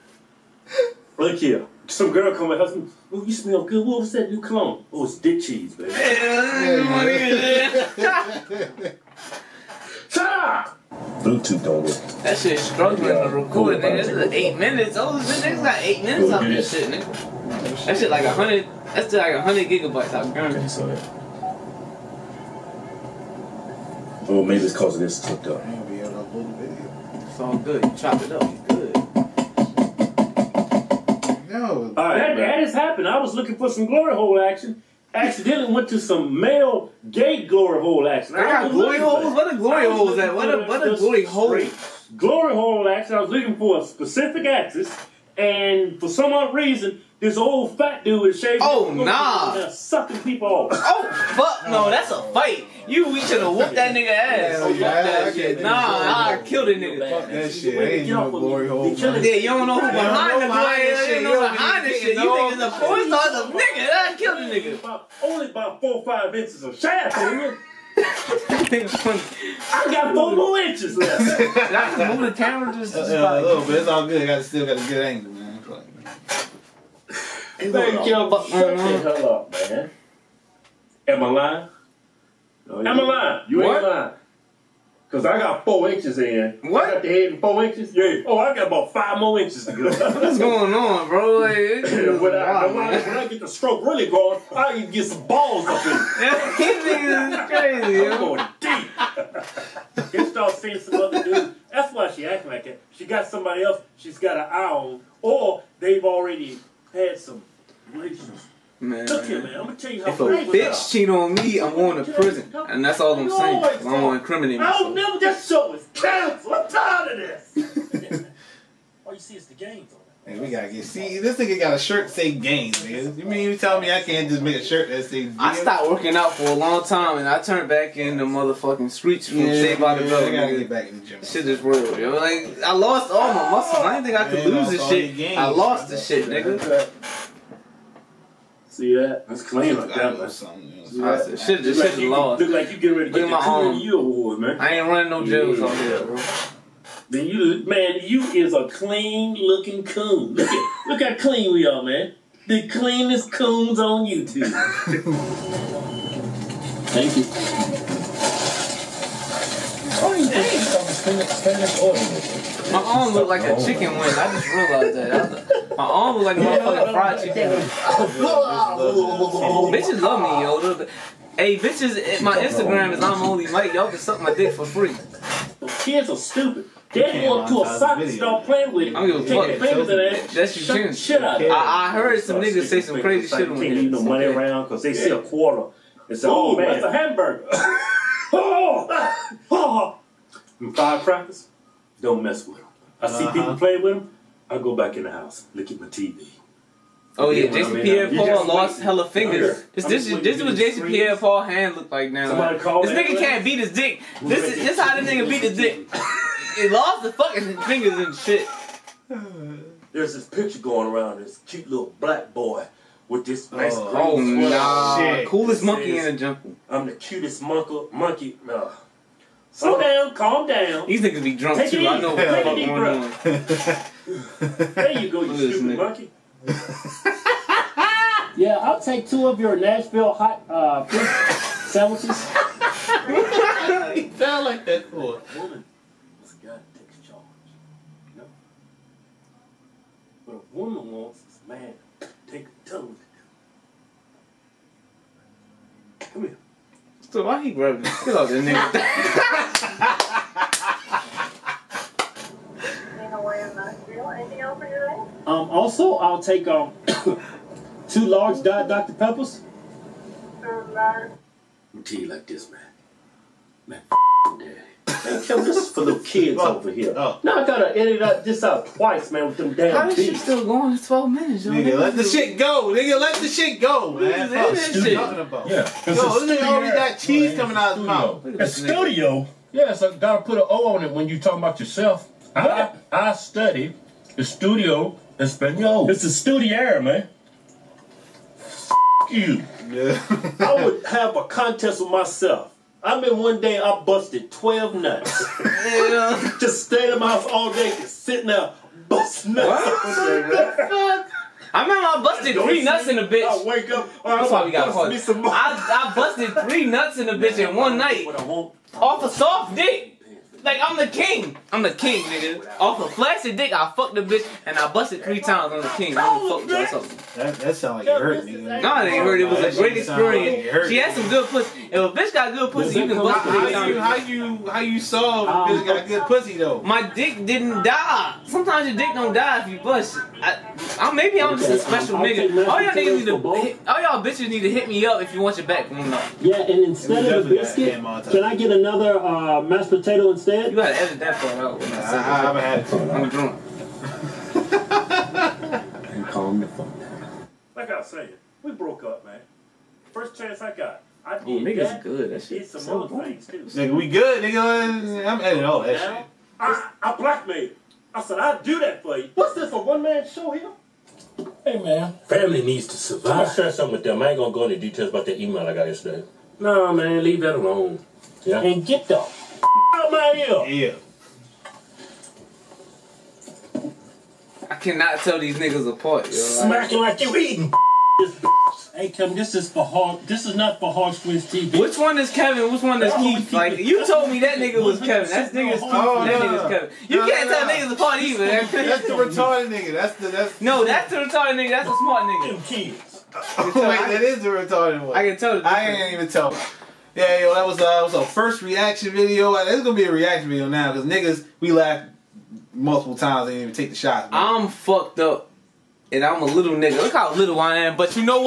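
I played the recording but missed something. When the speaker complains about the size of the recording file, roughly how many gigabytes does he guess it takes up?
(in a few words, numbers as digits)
100 gigabytes.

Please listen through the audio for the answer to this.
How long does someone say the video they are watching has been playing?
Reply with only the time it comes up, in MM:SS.
04:30.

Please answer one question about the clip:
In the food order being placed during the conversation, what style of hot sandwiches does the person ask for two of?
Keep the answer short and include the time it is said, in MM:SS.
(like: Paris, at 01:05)
Nashville hot, at 03:49.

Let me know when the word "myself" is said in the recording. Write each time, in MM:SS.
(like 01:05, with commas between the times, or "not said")
01:54, 04:51.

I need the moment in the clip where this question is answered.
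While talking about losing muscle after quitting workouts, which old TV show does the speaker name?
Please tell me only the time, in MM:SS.
02:09.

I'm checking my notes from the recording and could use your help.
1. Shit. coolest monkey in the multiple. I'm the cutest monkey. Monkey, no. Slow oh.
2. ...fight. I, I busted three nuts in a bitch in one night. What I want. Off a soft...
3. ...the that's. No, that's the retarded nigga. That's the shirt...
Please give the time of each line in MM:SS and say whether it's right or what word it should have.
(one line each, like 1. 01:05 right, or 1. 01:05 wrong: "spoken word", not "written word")
1. 03:34 wrong: "jungle", not "multiple"
2. 05:04 wrong: "caught", not "fight"
3. 06:29 wrong: "smart", not "shirt".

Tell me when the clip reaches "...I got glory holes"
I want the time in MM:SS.
00:38.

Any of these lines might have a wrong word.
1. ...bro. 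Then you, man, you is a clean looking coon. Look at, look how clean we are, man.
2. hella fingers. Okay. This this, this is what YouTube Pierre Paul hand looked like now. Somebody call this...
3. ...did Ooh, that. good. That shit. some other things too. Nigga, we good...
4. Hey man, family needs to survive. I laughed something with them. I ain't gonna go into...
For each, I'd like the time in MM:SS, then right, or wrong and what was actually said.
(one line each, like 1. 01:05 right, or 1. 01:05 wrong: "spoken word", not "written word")
1. 02:26 right
2. 03:18 wrong: "Jason", not "YouTube"
3. 05:51 right
4. 06:01 wrong: "shared", not "laughed".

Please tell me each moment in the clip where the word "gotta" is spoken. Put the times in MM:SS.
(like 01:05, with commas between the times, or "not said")
02:00, 02:10, 04:27, 04:39, 05:40.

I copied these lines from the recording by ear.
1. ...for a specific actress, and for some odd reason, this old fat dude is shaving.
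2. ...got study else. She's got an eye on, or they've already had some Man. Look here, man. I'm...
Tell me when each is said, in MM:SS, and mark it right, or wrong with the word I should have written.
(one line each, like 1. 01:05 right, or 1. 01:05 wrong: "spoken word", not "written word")
1. 00:43 right
2. 01:43 wrong: "somebody", not "study".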